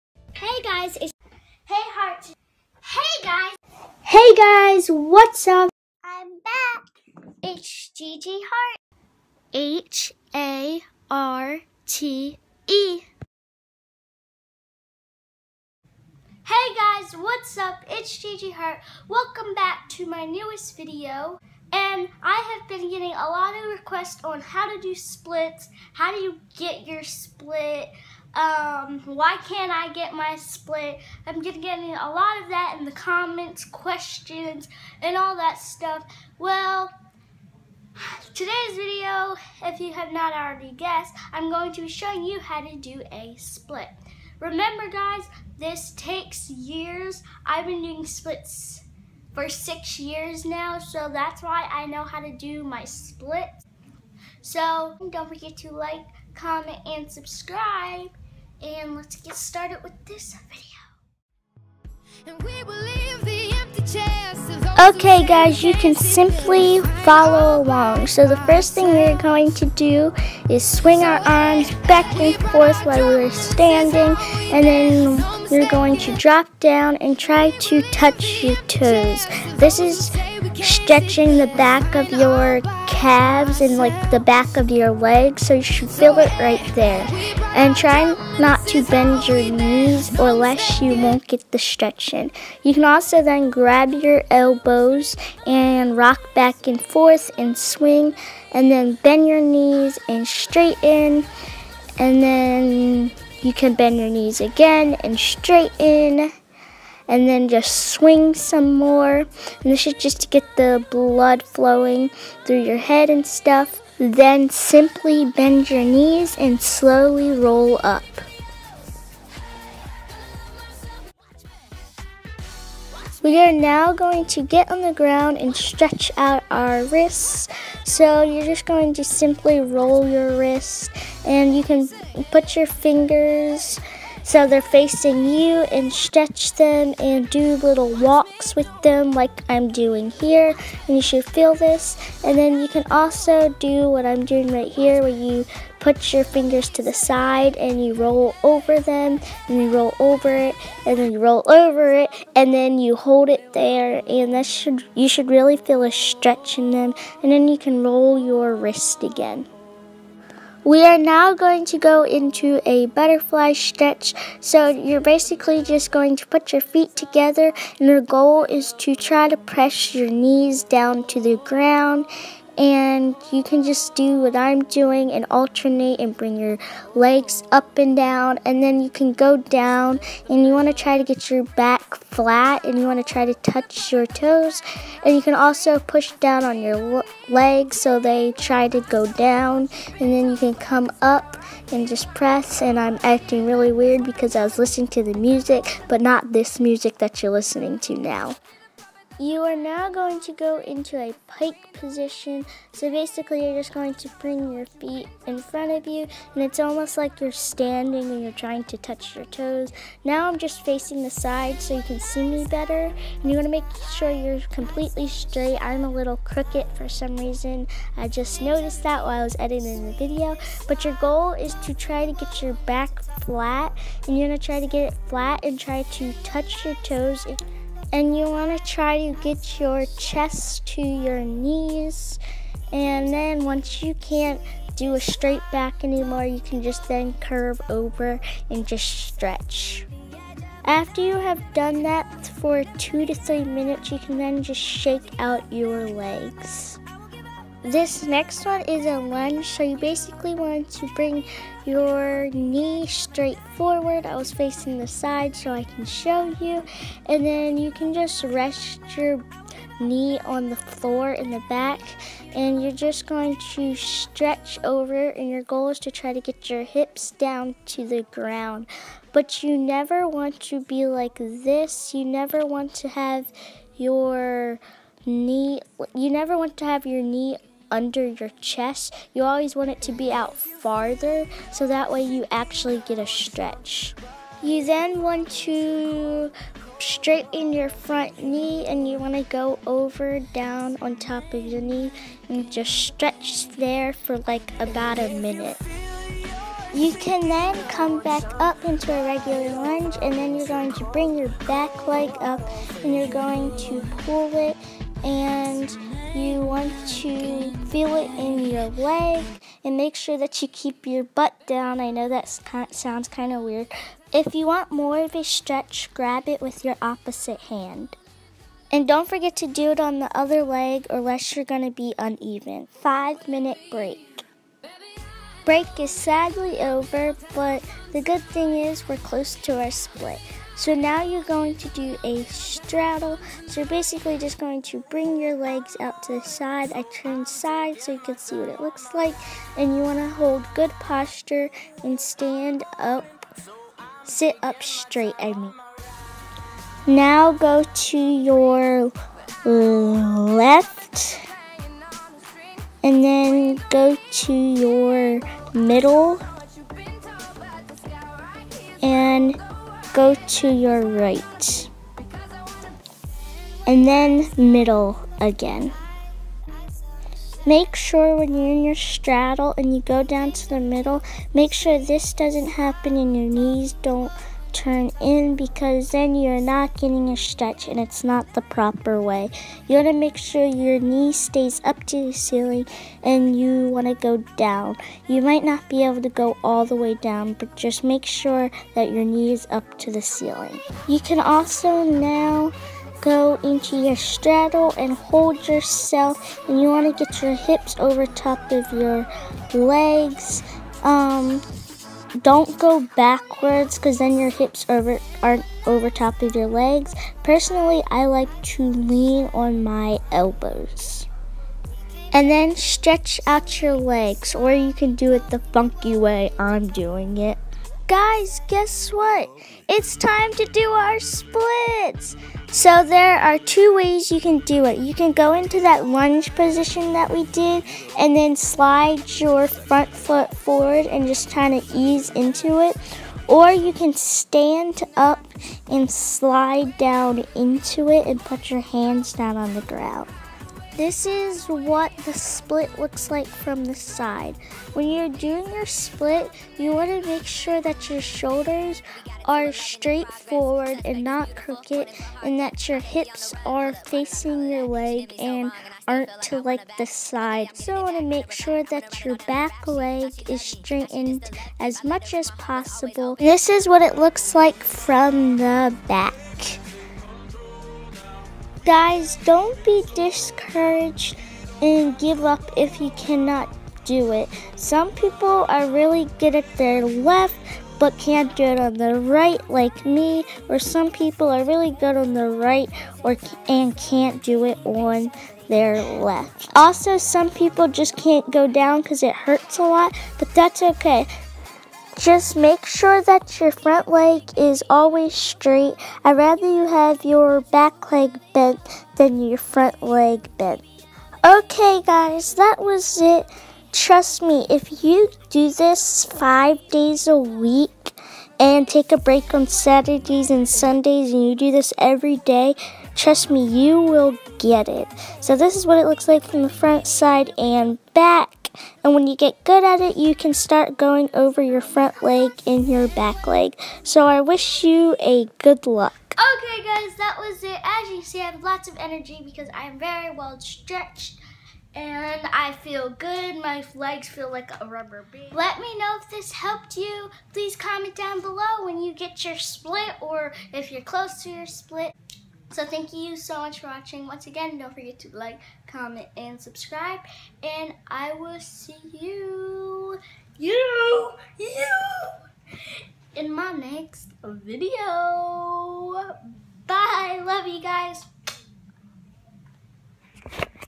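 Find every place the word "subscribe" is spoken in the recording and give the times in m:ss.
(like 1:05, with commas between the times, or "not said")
0:57, 9:06.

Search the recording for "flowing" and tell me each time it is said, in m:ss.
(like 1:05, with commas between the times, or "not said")
1:51.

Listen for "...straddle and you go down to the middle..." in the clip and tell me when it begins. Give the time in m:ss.
6:08.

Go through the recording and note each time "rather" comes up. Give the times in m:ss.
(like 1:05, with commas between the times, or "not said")
8:16.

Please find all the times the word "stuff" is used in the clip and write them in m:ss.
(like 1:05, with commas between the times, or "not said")
0:35, 1:53.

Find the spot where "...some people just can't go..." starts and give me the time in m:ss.
8:06.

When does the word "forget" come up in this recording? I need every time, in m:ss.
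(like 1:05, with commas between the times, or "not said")
0:55, 5:19, 9:04.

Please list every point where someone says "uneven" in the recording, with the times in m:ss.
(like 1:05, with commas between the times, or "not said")
5:21.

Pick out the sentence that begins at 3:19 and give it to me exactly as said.
You are now going to go into a pike position.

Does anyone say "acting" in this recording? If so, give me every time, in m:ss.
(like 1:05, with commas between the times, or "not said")
3:13.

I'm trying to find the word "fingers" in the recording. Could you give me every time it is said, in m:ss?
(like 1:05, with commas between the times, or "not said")
2:12, 2:26.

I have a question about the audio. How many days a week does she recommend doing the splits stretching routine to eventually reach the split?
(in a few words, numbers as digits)
5.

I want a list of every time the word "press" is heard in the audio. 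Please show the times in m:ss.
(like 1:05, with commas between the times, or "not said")
2:49, 3:12.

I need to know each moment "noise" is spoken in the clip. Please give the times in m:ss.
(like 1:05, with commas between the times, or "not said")
not said.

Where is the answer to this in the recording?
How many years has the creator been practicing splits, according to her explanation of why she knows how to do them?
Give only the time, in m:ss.
0:49.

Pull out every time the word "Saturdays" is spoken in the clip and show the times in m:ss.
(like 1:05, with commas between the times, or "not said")
8:29.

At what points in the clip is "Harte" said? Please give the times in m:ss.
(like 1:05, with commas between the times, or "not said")
0:08, 0:18.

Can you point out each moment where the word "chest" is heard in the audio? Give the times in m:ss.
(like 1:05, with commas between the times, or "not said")
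3:49, 4:38.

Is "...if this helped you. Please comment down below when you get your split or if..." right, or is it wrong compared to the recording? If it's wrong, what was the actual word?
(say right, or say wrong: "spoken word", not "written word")
right.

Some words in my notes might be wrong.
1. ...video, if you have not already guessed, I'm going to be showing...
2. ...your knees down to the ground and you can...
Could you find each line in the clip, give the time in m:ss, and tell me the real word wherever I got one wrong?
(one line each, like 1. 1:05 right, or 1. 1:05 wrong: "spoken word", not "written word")
1. 0:38 right
2. 2:49 right.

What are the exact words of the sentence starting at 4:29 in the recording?
But you never want to be like this.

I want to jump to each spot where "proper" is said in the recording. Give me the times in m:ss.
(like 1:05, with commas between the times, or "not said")
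6:18.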